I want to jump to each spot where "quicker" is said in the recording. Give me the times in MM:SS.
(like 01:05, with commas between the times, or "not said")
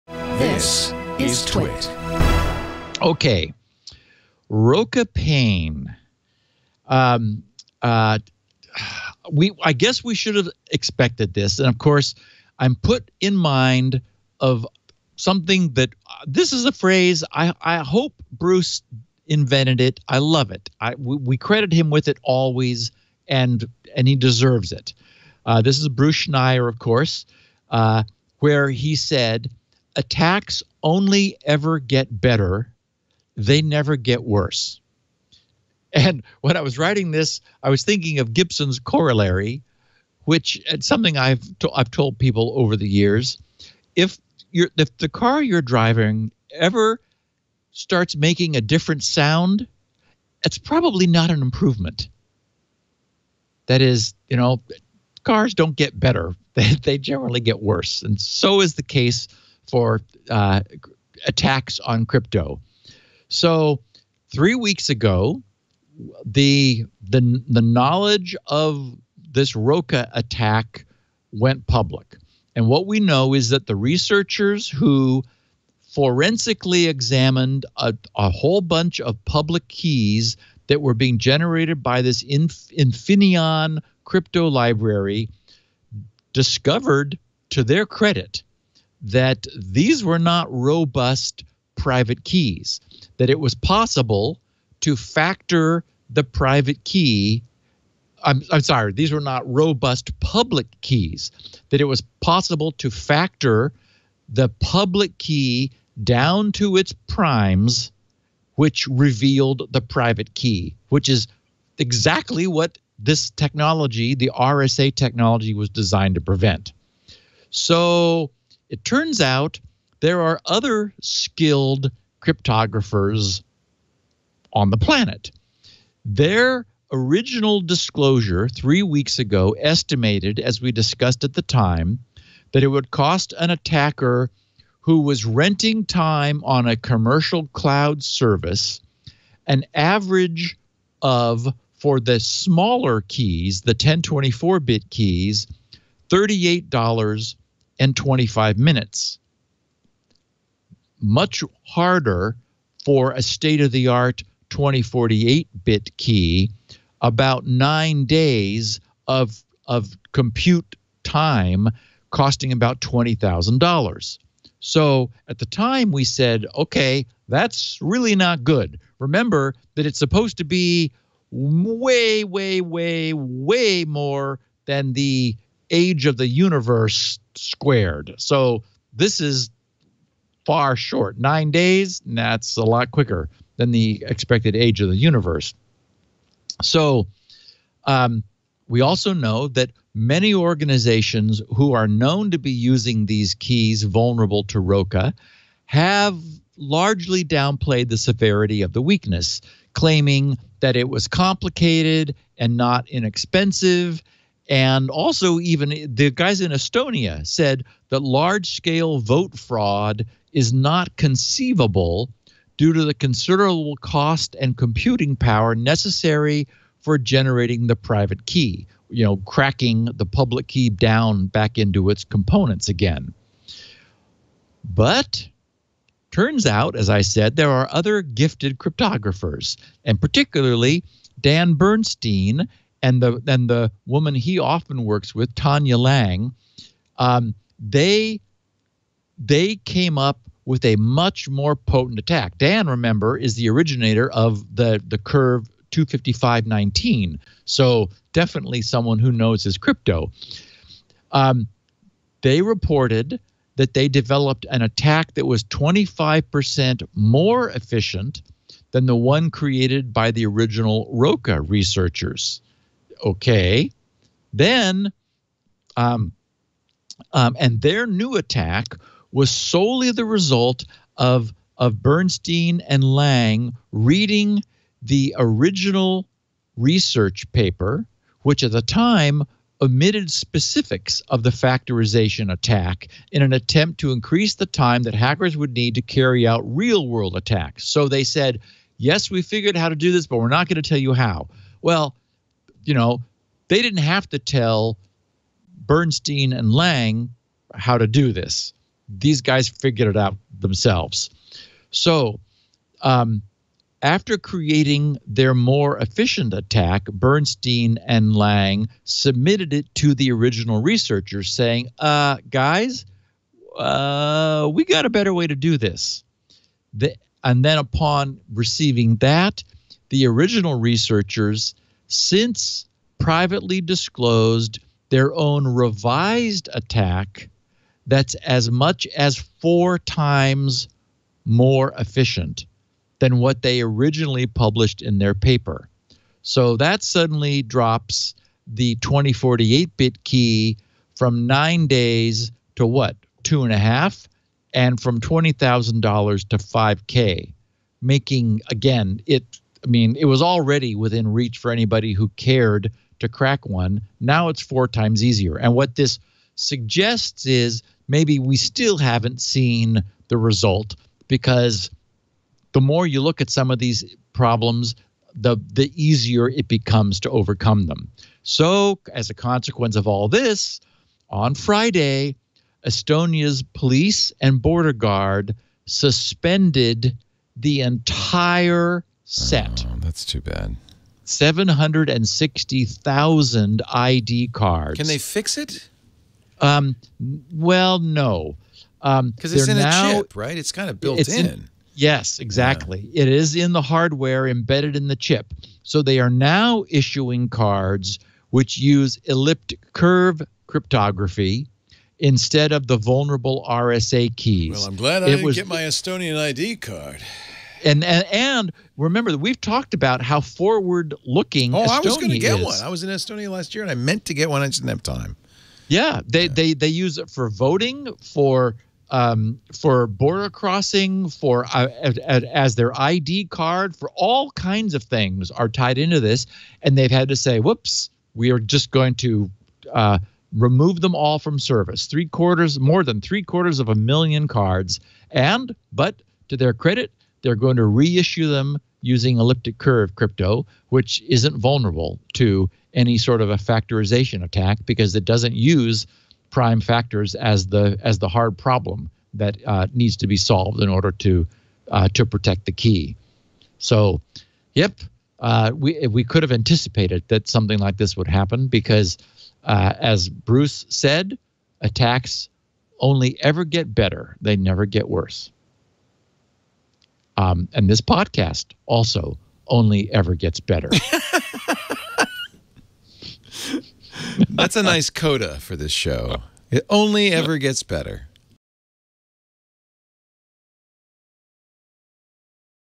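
03:02.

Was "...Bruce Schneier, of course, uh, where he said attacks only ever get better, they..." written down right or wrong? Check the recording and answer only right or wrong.
right.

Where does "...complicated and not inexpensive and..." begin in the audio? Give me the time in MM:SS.
03:21.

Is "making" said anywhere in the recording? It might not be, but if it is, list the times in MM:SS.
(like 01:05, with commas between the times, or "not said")
00:48, 05:47.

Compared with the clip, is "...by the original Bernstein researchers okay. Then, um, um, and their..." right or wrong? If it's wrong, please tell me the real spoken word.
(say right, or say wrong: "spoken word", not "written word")
wrong: "Roca", not "Bernstein".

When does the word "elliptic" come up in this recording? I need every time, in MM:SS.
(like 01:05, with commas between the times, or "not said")
06:39, 07:19.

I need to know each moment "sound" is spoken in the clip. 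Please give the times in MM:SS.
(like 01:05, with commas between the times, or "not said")
00:49.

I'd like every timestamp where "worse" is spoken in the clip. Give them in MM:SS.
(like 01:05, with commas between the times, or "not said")
00:34, 00:57, 07:44.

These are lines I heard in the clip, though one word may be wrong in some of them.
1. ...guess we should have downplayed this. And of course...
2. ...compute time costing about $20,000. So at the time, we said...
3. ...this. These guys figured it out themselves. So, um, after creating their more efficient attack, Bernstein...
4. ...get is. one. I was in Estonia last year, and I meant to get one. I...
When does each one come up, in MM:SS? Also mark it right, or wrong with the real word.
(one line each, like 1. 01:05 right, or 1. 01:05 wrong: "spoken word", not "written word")
1. 00:09 wrong: "expected", not "downplayed"
2. 02:40 right
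3. 04:58 right
4. 06:52 right.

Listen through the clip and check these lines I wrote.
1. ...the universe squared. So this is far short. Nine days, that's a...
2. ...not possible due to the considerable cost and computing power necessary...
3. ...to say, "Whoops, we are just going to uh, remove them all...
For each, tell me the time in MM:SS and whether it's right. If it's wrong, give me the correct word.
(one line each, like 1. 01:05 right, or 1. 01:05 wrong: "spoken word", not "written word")
1. 02:56 right
2. 03:30 wrong: "conceivable", not "possible"
3. 07:07 right.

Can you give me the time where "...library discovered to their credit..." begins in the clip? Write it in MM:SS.
01:24.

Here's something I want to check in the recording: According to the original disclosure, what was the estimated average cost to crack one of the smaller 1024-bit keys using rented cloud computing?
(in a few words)
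$38.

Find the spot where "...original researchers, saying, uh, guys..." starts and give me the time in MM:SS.
05:10.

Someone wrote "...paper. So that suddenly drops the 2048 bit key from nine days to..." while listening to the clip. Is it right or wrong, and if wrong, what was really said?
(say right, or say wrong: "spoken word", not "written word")
right.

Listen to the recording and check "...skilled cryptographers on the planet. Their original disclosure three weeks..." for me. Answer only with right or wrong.
right.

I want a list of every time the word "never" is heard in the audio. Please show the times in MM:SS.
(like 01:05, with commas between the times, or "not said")
00:33, 07:44.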